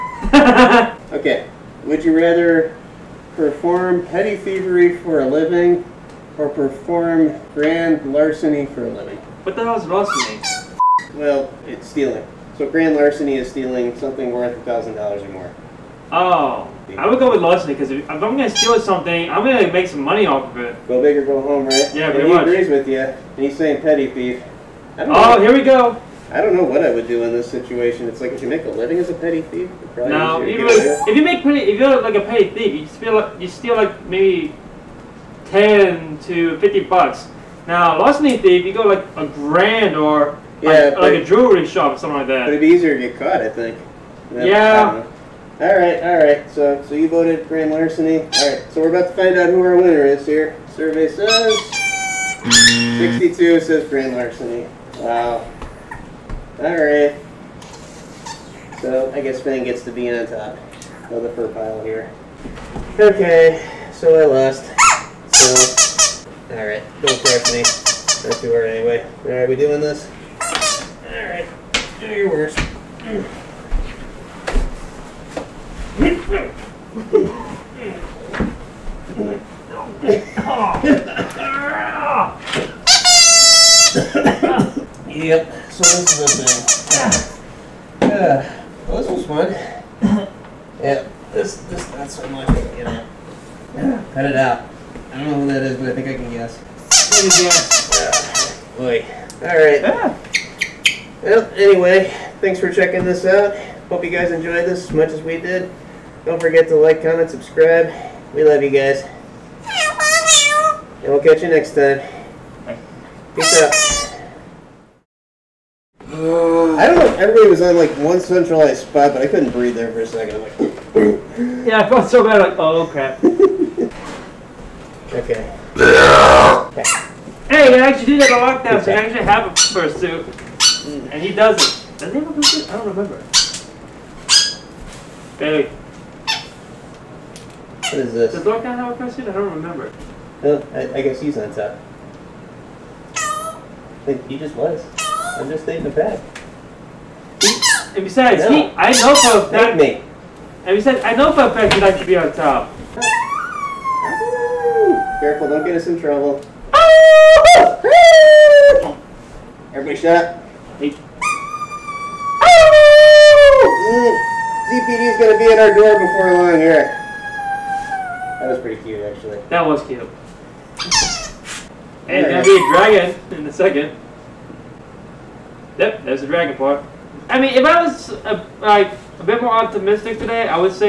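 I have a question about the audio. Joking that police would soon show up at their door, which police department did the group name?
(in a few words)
ZPD.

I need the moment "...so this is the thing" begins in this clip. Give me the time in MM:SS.
01:25.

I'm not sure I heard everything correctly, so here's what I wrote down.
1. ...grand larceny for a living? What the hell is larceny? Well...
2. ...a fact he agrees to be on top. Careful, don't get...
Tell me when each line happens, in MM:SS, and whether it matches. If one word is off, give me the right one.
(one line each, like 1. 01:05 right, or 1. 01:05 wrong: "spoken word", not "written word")
1. 00:07 right
2. 02:31 wrong: "likes", not "agrees".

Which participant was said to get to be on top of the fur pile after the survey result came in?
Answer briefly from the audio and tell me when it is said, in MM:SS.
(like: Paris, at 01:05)
Finn, at 00:59.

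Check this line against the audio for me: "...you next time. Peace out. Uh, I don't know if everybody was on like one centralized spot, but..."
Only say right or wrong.
right.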